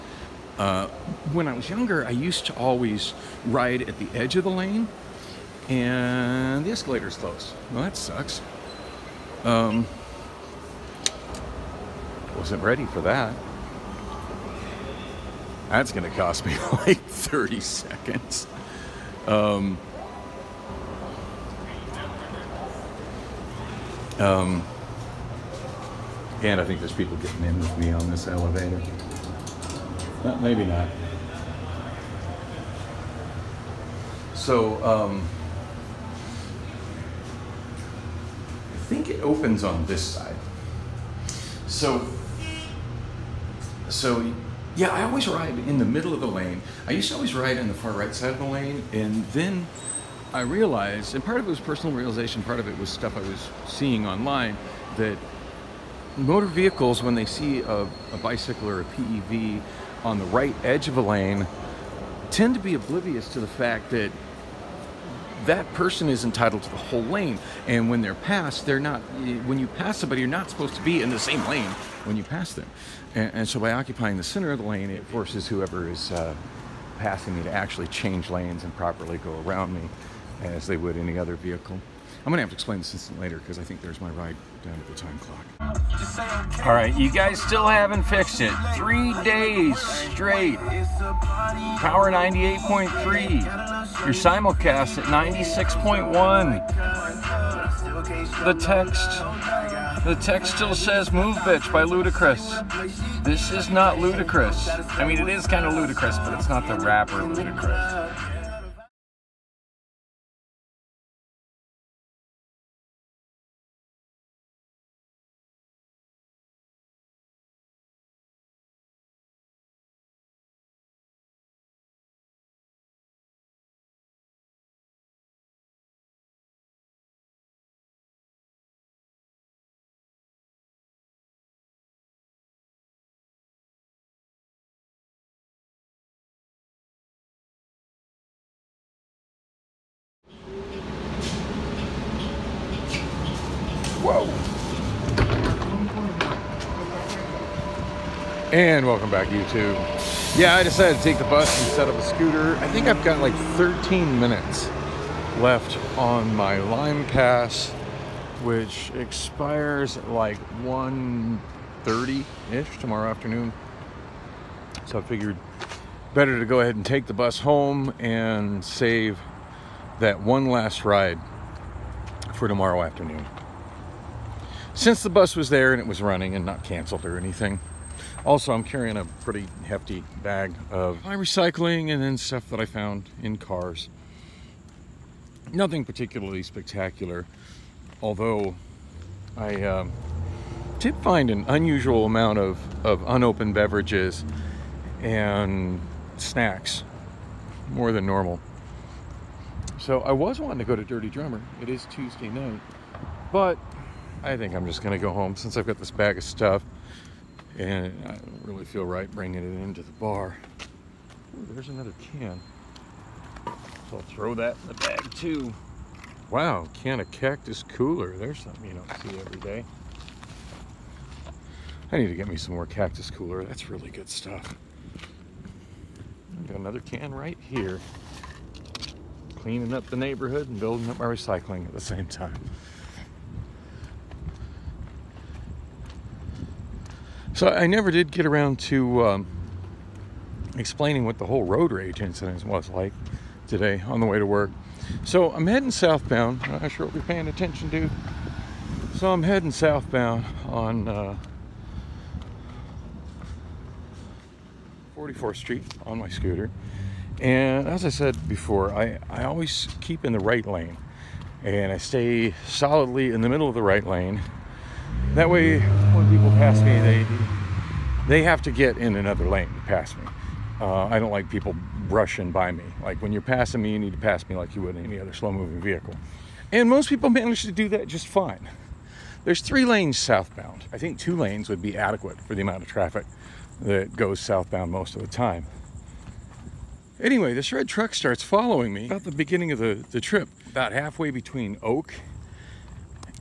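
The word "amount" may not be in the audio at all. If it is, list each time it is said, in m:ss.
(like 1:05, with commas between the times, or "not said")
3:12, 4:42.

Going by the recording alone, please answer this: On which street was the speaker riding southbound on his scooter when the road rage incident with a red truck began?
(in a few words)
44th Street.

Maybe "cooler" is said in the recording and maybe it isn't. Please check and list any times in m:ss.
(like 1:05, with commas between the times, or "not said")
3:37, 3:43.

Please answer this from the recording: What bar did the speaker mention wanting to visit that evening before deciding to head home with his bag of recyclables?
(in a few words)
Dirty Drummer.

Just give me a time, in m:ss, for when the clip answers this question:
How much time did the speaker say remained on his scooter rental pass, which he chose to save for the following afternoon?
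2:33.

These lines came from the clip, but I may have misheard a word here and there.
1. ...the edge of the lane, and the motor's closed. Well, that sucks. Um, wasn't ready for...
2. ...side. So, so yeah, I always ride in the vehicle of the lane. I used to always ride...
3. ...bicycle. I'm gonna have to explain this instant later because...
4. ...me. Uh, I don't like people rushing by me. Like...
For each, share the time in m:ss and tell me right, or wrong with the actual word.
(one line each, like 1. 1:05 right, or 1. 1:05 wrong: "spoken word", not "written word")
1. 0:03 wrong: "escalator", not "motor"
2. 0:40 wrong: "middle", not "vehicle"
3. 1:21 wrong: "vehicle", not "bicycle"
4. 4:29 right.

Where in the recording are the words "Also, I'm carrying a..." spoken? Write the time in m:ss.
2:58.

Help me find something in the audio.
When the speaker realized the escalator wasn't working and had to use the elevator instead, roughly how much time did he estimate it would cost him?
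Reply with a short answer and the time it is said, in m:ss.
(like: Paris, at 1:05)
30 seconds, at 0:16.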